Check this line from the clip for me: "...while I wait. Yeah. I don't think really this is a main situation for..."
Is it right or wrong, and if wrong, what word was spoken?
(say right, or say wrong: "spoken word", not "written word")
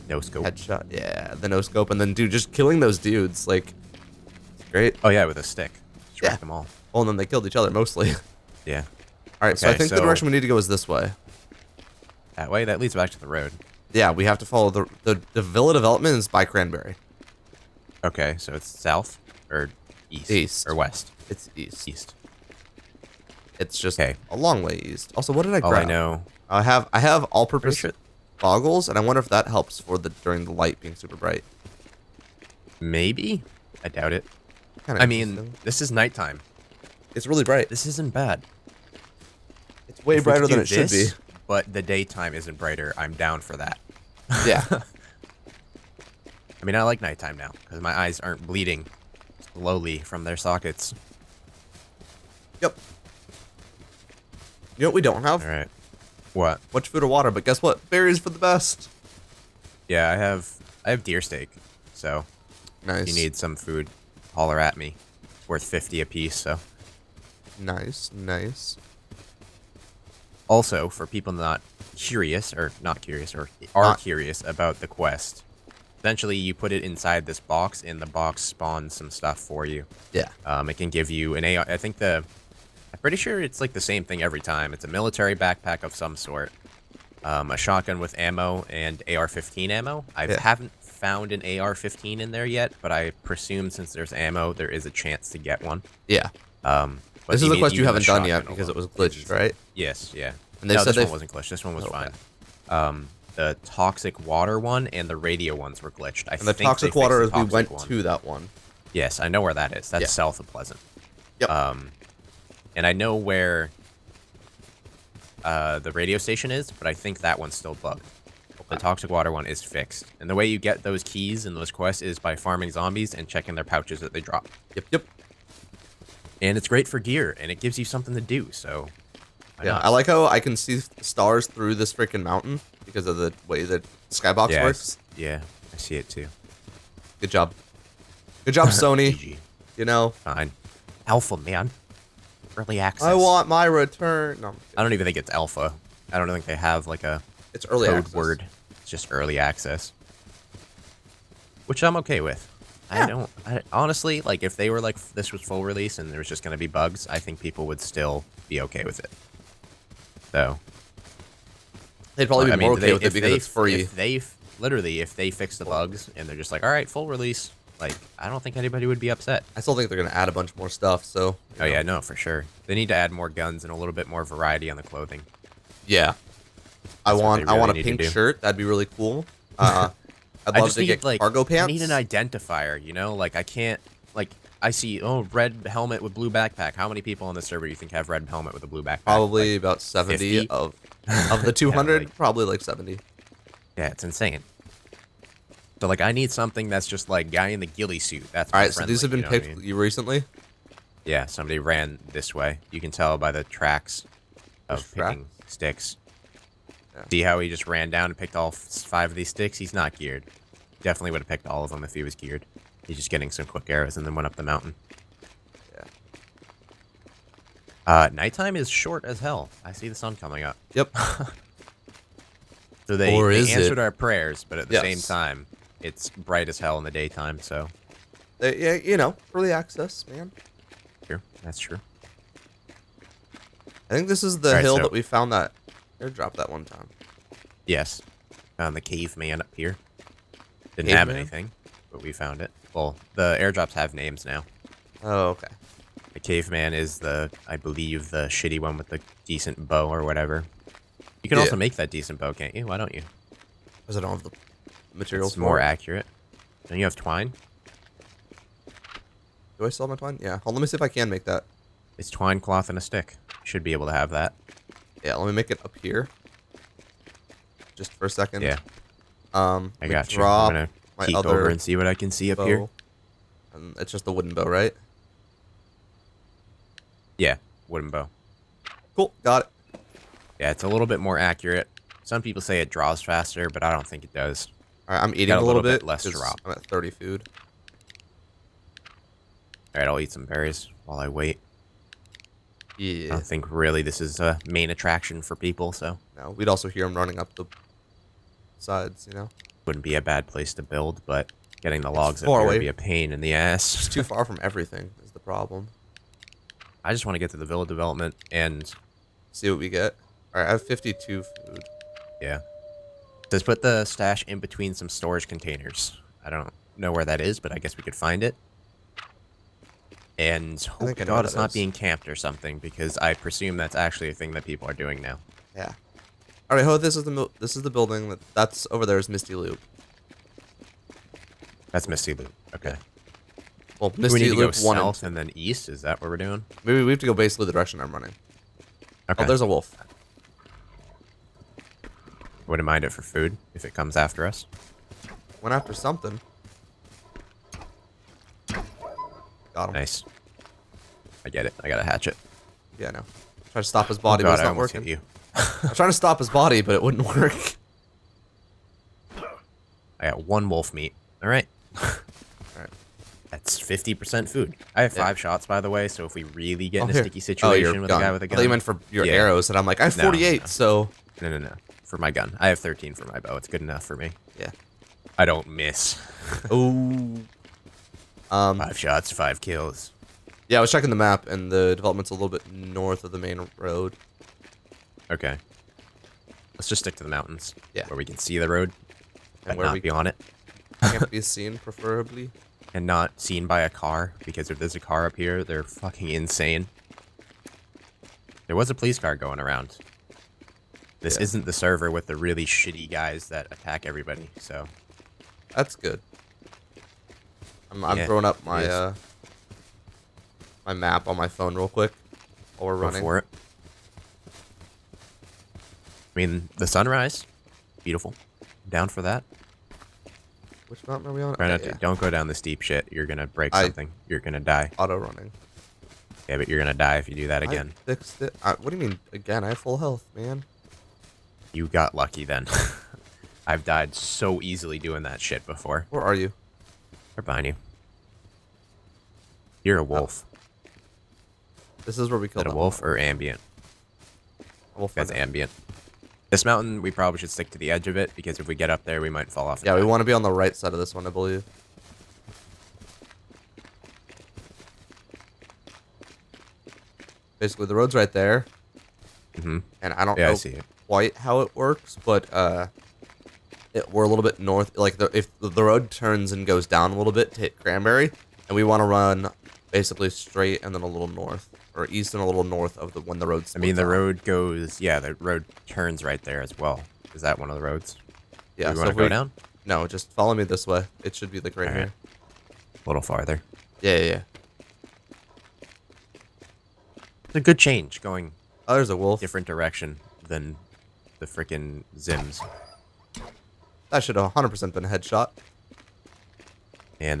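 wrong: "attraction", not "situation".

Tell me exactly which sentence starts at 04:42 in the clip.
Some people say it draws faster, but I don't think it does.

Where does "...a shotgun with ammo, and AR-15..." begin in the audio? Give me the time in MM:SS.
01:27.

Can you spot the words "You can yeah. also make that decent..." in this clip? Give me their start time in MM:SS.
04:11.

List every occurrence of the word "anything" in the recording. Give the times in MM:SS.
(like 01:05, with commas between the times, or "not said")
04:01.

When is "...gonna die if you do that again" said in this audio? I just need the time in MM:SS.
07:06.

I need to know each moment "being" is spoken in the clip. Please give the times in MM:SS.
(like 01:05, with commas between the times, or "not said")
00:30, 05:21.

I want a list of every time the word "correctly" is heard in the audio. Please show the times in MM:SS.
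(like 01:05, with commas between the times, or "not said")
not said.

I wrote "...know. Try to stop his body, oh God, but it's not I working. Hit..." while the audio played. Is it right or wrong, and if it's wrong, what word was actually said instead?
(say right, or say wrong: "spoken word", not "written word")
right.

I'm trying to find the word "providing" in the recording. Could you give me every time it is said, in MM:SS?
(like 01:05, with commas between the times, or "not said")
not said.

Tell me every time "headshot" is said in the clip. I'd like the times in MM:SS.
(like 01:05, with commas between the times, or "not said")
00:00, 08:14.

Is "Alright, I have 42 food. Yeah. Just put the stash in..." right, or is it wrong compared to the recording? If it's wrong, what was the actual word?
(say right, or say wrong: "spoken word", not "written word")
wrong: "52", not "42".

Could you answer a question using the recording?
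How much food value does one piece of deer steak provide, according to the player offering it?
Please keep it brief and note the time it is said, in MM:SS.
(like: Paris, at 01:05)
50, at 01:05.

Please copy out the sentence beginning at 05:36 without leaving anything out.
Maybe we have to go basically the direction I'm running.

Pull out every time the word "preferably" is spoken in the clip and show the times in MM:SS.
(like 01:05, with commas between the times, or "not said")
06:31.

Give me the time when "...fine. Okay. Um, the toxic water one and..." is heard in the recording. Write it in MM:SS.
01:41.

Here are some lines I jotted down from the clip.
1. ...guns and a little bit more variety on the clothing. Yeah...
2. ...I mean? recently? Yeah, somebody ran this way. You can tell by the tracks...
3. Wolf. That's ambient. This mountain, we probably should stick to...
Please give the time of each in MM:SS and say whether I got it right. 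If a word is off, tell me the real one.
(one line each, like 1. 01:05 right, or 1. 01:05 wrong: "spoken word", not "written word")
1. 02:53 right
2. 03:19 right
3. 07:24 right.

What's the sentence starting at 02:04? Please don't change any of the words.
Yep, yep and it's great for gear, and it gives you something to do.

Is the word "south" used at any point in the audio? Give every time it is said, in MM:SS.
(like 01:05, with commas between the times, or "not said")
00:18, 01:50, 05:34.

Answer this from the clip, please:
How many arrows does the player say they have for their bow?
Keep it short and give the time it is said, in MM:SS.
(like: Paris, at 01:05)
13, at 06:12.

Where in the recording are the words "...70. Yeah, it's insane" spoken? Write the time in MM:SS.
03:12.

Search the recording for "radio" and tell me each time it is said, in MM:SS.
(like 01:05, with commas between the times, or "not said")
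01:45, 01:55.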